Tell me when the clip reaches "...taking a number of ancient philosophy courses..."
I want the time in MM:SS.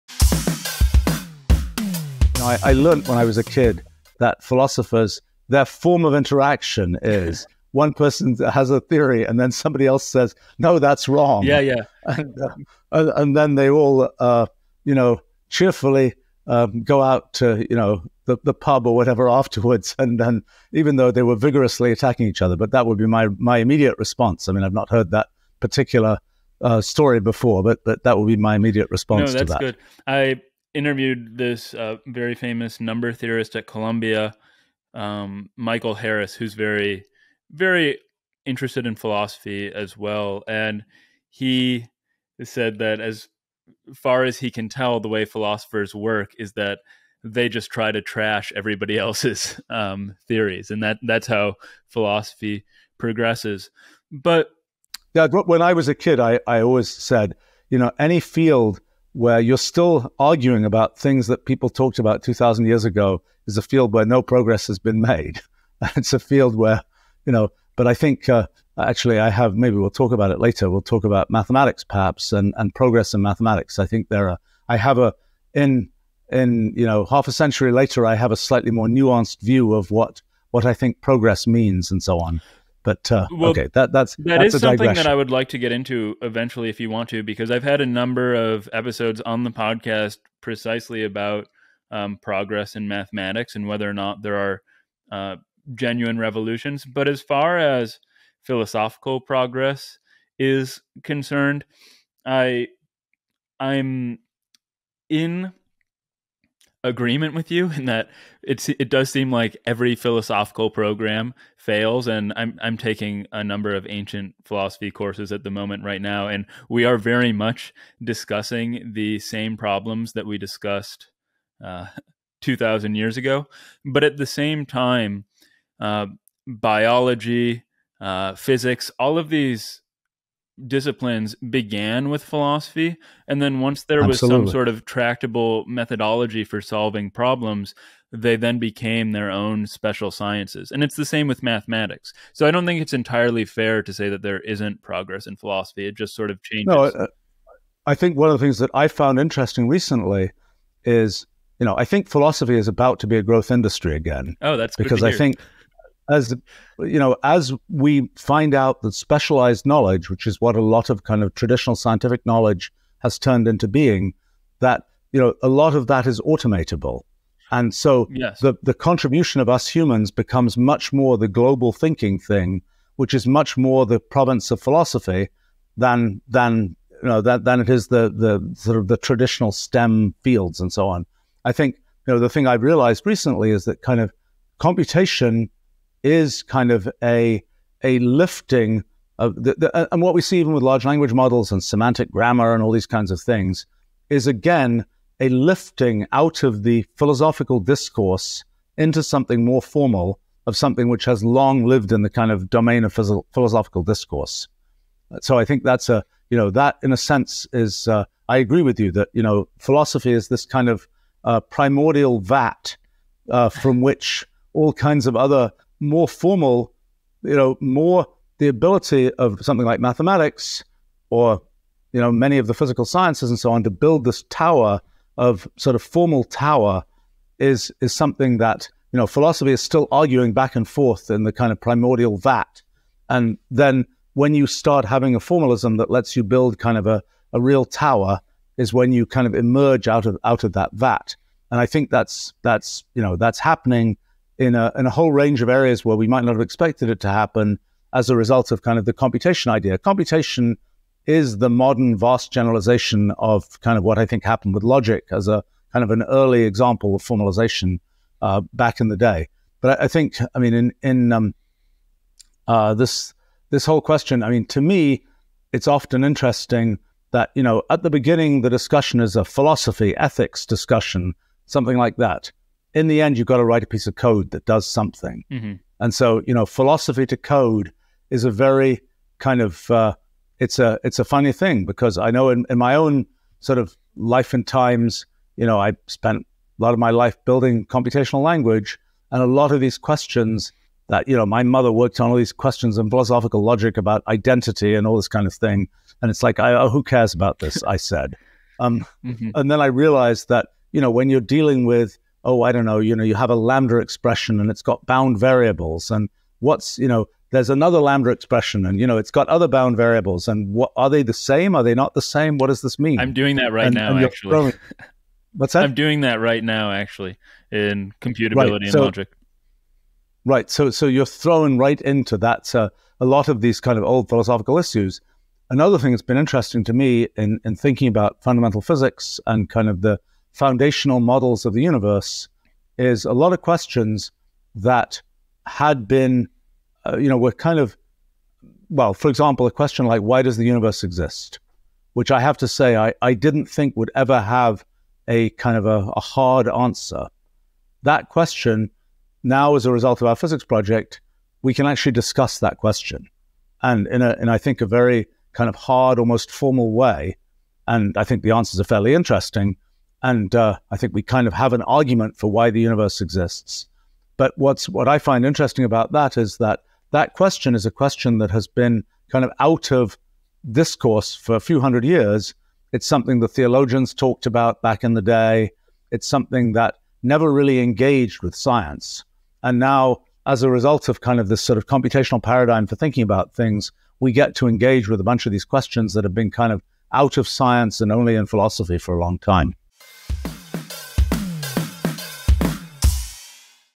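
01:52.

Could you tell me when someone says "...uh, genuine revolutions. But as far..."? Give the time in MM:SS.
01:35.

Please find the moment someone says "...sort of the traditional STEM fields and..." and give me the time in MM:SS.
02:58.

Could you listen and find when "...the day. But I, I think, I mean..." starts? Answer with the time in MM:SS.
04:18.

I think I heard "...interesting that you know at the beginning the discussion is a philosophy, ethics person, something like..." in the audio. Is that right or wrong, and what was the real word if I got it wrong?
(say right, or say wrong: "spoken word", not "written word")
wrong: "discussion", not "person".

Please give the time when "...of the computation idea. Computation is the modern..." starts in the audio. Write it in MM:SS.
04:08.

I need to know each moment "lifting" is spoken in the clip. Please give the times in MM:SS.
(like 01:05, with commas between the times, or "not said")
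03:07, 03:15.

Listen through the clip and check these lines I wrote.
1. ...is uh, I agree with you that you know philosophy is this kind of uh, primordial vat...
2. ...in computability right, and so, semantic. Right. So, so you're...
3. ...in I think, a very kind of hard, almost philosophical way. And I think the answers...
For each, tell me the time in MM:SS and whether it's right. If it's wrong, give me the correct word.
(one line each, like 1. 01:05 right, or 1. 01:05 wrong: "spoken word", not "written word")
1. 03:27 right
2. 05:17 wrong: "logic", not "semantic"
3. 05:54 wrong: "formal", not "philosophical".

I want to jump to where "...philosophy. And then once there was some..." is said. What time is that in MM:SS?
02:12.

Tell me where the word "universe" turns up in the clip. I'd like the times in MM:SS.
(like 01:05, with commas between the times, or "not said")
05:31, 05:40, 06:02.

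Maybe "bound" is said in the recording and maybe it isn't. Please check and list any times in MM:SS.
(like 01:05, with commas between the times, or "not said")
05:04, 05:09.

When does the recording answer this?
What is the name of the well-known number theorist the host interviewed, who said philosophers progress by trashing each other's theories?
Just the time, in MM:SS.
00:35.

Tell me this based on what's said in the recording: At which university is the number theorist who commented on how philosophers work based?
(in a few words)
Columbia.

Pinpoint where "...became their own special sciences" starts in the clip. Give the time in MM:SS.
02:18.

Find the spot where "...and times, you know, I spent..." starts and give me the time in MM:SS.
04:44.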